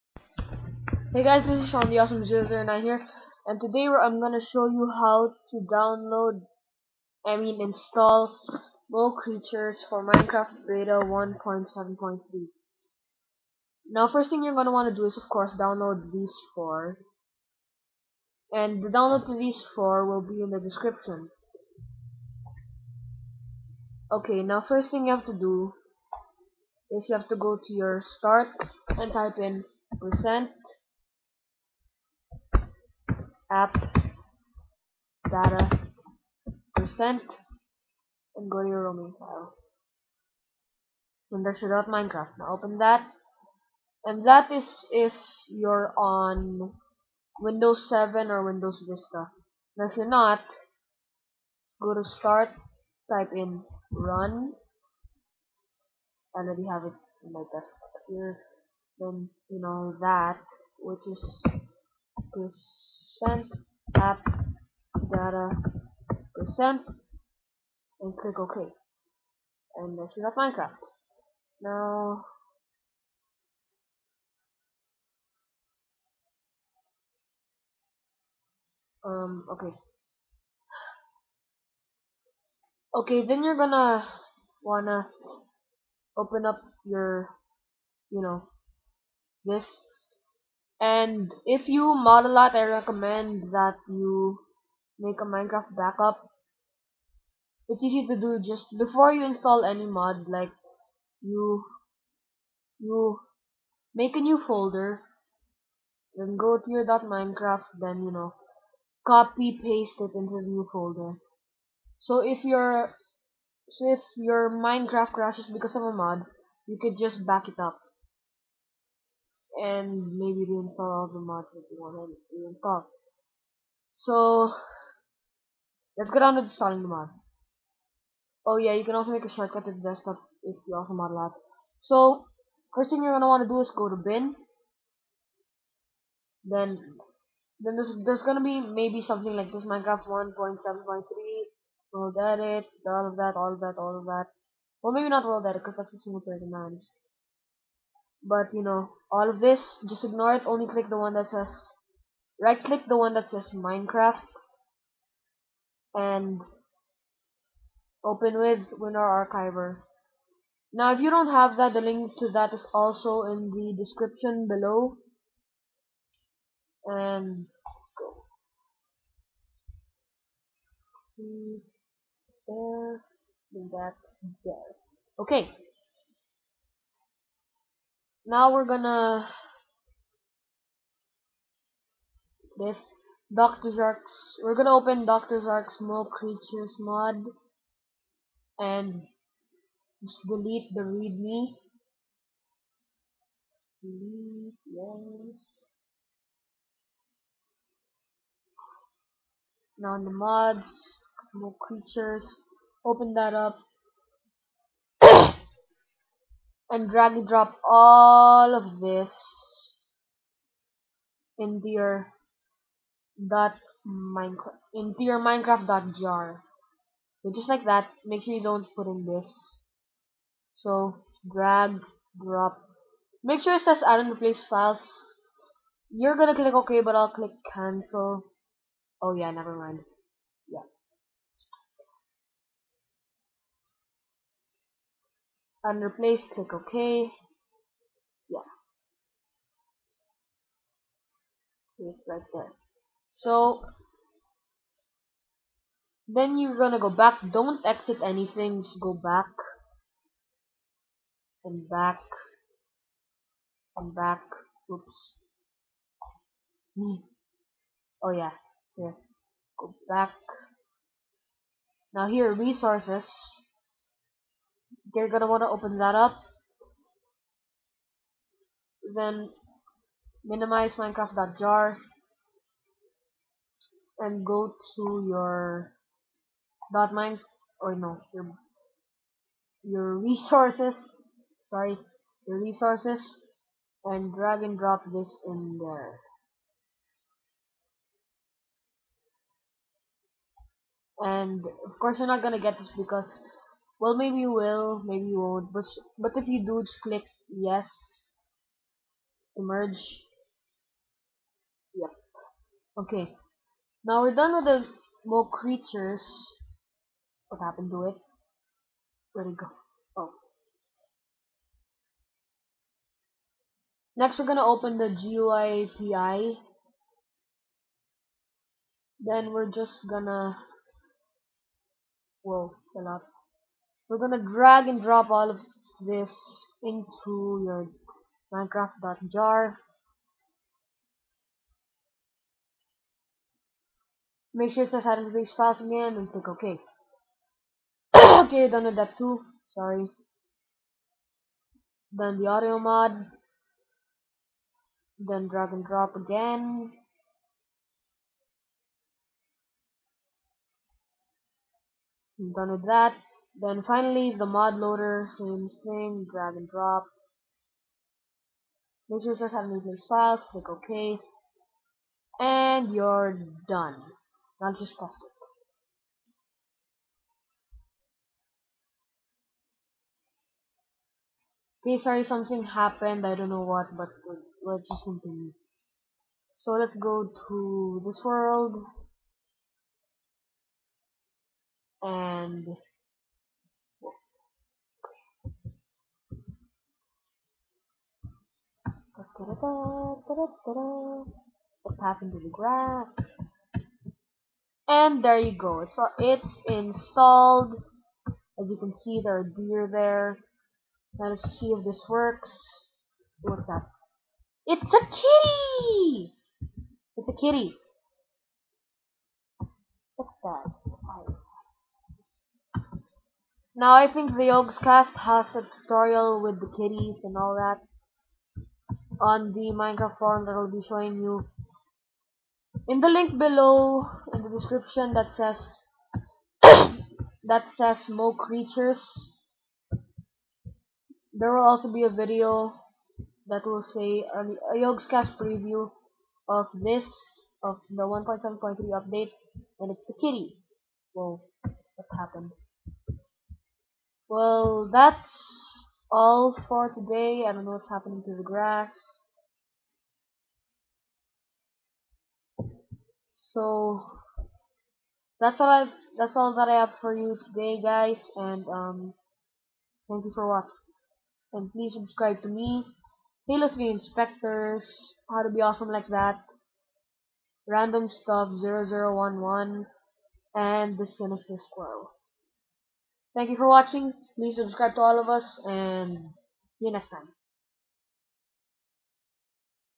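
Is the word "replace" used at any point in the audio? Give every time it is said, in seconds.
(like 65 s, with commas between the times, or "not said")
224 s, 235 s.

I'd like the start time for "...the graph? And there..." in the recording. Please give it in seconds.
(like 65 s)
392 s.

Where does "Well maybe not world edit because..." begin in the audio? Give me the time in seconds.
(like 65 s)
144 s.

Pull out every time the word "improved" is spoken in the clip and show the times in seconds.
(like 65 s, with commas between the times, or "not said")
not said.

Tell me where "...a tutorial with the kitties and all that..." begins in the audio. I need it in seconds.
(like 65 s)
415 s.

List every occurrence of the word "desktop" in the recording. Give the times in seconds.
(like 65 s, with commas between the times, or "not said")
57 s, 129 s.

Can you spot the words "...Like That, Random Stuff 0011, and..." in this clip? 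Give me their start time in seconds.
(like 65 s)
465 s.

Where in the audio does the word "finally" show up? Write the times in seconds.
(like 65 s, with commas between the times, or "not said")
353 s.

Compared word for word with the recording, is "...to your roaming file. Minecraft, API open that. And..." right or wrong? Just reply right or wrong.
wrong.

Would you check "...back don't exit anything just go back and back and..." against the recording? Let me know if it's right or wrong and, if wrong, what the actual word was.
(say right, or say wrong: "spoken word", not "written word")
right.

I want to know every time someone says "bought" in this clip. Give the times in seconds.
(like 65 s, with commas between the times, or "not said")
not said.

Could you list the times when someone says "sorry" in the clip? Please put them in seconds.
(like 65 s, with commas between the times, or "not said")
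281 s, 339 s, 371 s.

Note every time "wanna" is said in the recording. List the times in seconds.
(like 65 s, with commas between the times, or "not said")
14 s, 84 s, 265 s.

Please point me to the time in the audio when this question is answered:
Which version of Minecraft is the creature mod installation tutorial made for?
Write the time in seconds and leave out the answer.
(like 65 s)
10 s.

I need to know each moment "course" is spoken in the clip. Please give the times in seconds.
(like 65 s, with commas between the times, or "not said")
15 s, 291 s.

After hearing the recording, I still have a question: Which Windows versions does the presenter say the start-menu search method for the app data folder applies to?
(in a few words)
Windows 7 or Vista.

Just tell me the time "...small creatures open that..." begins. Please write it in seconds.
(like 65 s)
201 s.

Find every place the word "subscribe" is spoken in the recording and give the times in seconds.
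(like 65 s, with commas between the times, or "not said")
461 s, 474 s.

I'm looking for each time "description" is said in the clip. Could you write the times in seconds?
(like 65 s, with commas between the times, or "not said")
20 s, 163 s, 424 s.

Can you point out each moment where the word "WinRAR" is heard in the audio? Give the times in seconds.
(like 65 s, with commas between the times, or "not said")
158 s.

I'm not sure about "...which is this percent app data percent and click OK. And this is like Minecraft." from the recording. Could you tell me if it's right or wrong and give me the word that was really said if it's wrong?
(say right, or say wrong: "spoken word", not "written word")
right.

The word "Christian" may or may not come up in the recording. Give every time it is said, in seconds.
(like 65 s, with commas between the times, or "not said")
not said.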